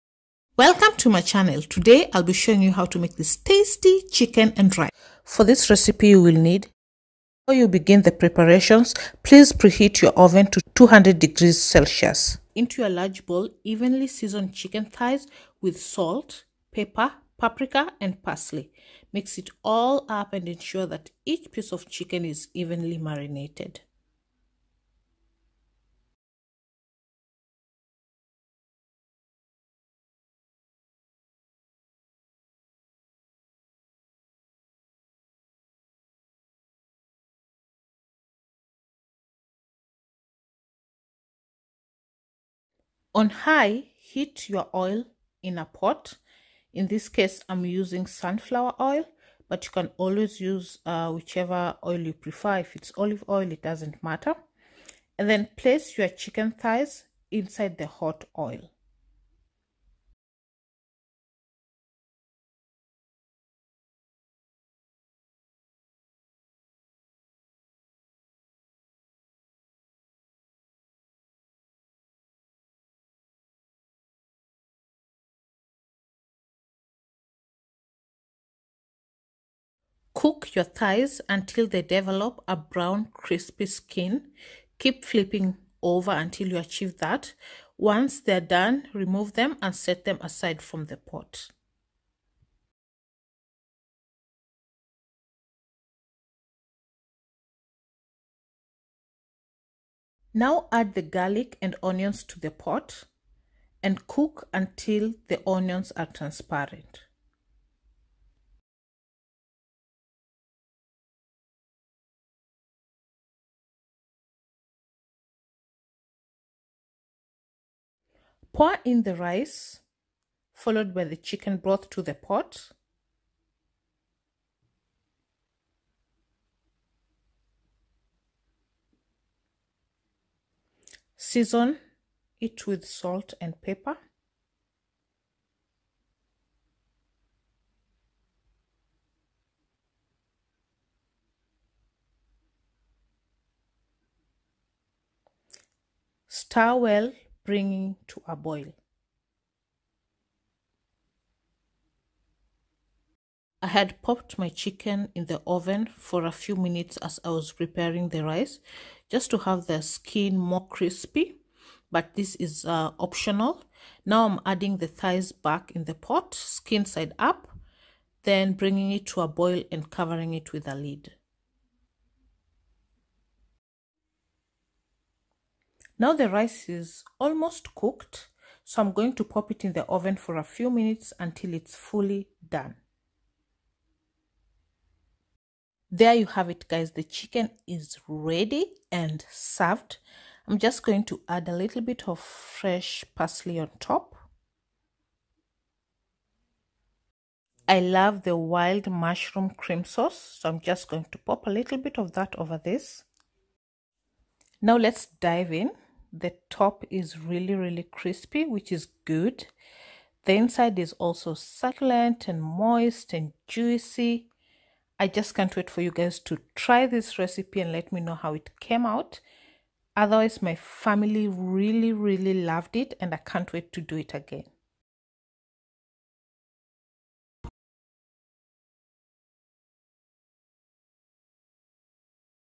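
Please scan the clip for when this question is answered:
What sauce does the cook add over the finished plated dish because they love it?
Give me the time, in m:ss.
3:18.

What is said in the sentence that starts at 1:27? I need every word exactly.
Once they're done, remove them and set them aside from the pot.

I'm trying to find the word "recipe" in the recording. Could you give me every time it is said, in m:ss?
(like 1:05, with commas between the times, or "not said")
0:05, 3:37.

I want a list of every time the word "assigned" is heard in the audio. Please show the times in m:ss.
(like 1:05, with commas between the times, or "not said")
not said.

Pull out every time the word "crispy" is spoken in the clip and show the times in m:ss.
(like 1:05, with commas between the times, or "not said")
1:23, 2:40, 3:27.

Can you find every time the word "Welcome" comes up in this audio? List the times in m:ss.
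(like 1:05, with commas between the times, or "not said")
0:00.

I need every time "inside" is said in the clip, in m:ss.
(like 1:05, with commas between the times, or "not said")
0:57, 3:30.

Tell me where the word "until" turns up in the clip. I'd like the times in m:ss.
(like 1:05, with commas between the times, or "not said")
1:21, 1:26, 1:44, 3:01.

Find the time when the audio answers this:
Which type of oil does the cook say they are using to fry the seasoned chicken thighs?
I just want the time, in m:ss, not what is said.
0:48.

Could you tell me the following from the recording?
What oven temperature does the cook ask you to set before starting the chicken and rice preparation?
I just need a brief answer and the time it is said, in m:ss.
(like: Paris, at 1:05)
200 degrees Celsius, at 0:10.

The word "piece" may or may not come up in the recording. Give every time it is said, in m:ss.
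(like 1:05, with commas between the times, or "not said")
0:21.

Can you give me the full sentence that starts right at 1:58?
Pour in the rice, followed by the chicken broth to the pot.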